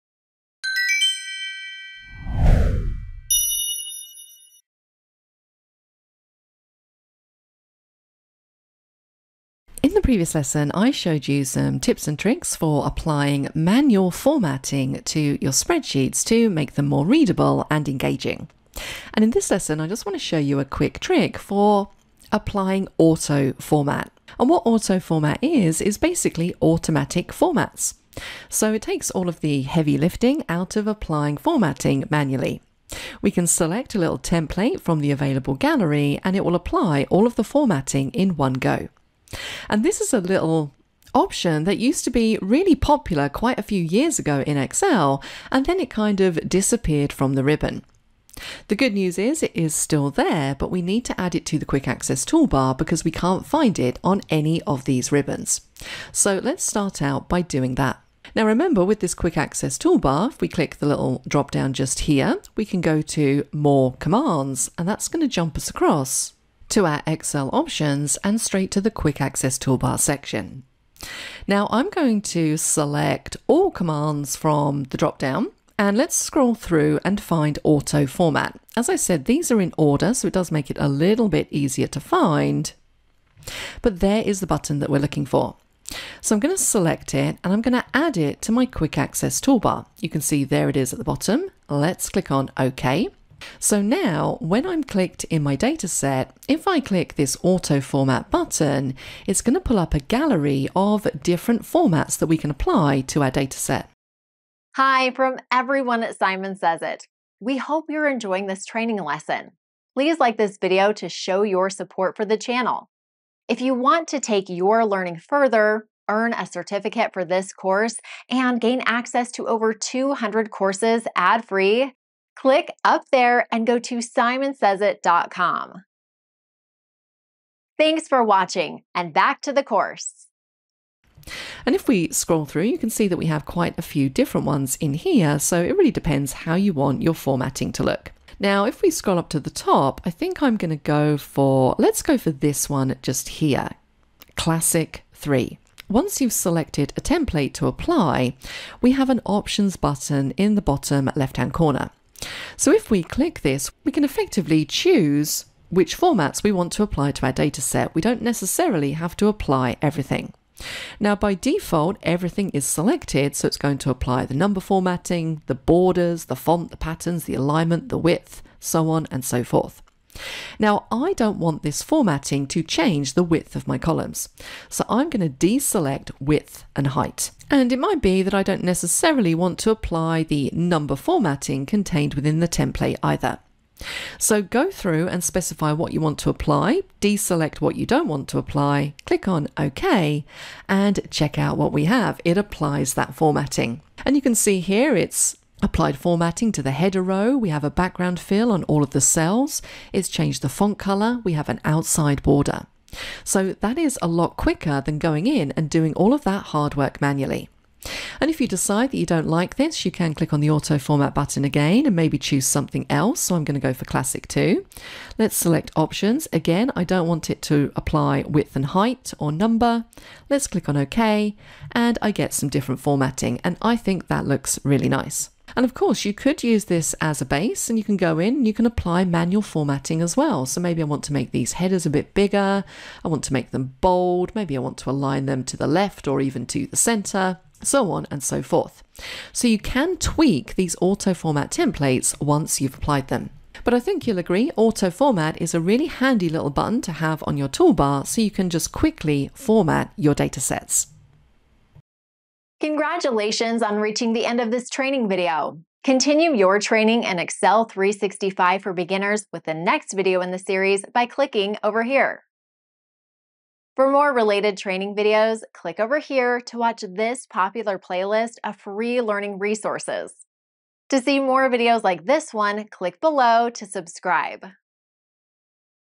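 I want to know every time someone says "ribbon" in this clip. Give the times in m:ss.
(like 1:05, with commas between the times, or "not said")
0:47, 0:55.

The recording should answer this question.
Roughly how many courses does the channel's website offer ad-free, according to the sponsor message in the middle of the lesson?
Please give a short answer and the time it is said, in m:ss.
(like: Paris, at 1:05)
200, at 1:59.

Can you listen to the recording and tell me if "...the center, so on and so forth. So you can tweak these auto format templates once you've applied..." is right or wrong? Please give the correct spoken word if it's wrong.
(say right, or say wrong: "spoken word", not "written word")
right.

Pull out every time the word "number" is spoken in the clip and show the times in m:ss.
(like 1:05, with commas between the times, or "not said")
2:44, 3:00, 3:39.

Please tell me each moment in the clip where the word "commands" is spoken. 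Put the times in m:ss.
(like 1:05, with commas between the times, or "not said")
1:03, 1:13.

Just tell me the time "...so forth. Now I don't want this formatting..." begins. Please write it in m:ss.
2:49.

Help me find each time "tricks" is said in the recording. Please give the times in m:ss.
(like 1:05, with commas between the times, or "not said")
0:12, 0:20.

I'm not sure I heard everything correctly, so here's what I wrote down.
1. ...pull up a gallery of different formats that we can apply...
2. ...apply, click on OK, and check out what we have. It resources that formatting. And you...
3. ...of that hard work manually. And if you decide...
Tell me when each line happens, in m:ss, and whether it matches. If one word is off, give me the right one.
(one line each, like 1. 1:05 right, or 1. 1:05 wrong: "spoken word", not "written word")
1. 1:39 right
2. 3:08 wrong: "applies", not "resources"
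3. 3:26 right.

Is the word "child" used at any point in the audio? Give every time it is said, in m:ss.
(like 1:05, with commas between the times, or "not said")
not said.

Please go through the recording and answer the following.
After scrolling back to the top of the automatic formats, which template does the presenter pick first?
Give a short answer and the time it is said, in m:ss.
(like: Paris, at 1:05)
Classic 3, at 2:24.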